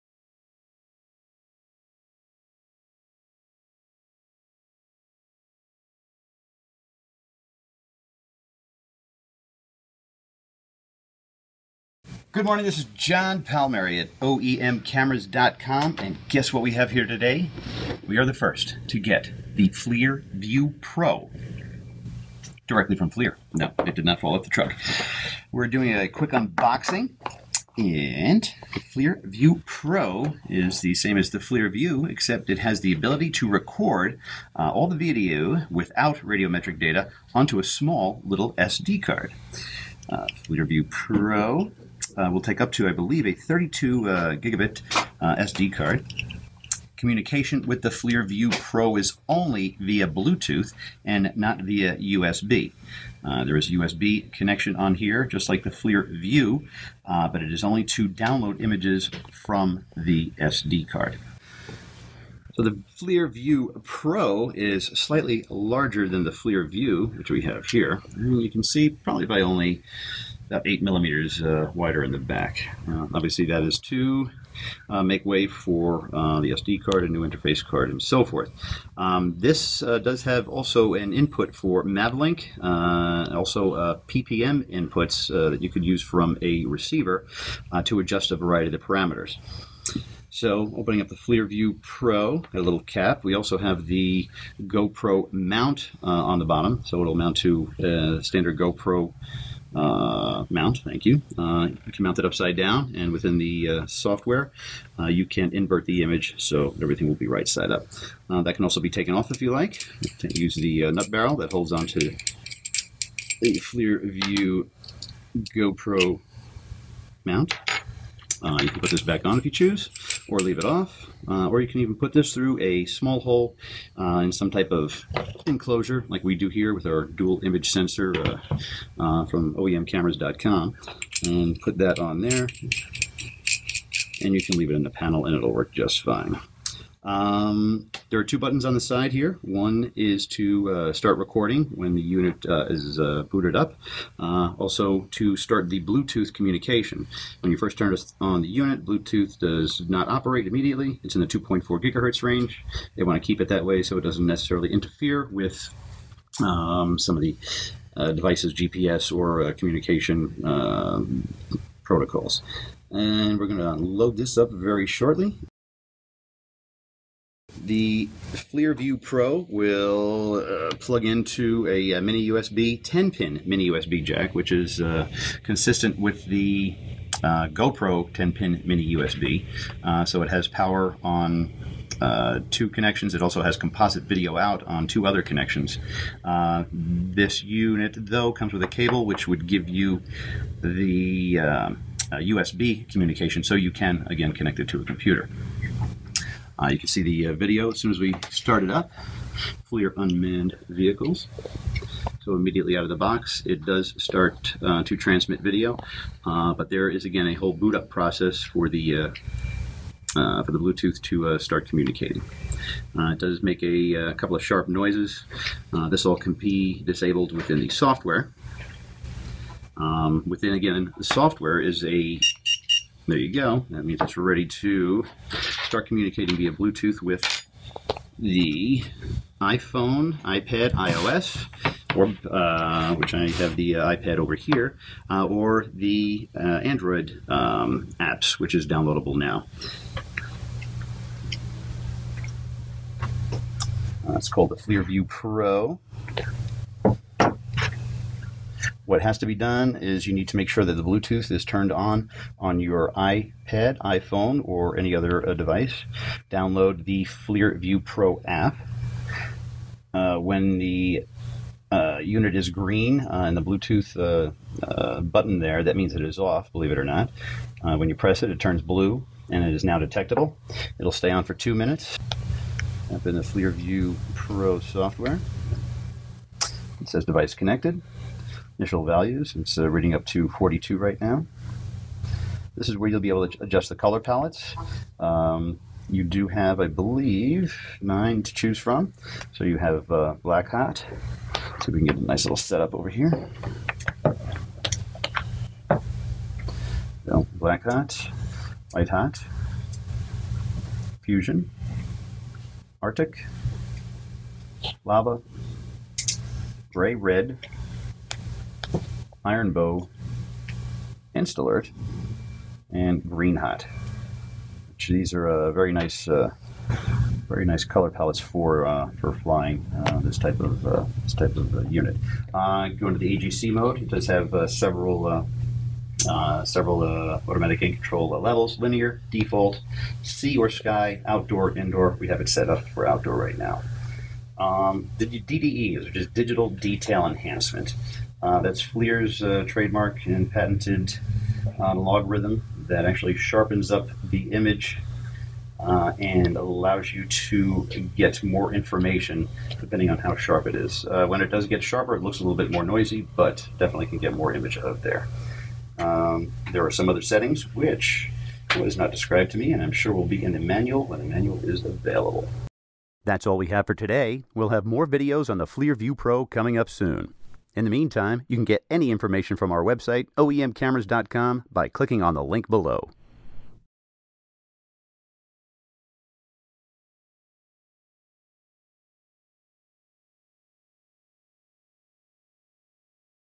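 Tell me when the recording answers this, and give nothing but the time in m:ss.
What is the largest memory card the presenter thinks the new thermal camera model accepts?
0:43.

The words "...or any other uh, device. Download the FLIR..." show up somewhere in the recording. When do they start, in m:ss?
4:14.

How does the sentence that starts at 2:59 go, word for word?
Uh, so it has power on uh, two connections.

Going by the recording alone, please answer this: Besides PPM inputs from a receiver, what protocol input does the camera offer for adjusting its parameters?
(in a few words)
MAVLink.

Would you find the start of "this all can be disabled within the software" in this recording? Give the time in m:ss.
3:35.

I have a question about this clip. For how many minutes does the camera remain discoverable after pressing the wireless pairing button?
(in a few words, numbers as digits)
2.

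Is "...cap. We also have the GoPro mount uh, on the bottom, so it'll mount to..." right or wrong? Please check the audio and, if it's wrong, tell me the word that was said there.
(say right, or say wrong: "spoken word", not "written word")
right.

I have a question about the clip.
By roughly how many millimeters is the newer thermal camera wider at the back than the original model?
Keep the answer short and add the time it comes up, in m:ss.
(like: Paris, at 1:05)
8, at 1:10.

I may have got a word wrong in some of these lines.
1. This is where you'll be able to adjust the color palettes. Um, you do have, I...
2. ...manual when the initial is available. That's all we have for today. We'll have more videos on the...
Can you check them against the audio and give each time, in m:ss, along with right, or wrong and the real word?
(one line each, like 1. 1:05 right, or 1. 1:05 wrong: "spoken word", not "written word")
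1. 4:42 right
2. 6:00 wrong: "manual", not "initial".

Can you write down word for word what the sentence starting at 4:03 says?
Uh, it's called the Clearview Pro.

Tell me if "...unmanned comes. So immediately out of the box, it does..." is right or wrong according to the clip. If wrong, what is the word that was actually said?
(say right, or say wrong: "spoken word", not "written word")
wrong: "vehicles", not "comes".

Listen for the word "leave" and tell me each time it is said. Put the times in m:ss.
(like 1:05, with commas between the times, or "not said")
2:00, 2:14.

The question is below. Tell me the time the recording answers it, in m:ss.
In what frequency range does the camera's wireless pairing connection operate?
2:31.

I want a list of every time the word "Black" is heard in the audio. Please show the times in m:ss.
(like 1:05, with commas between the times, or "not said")
4:50, 4:57.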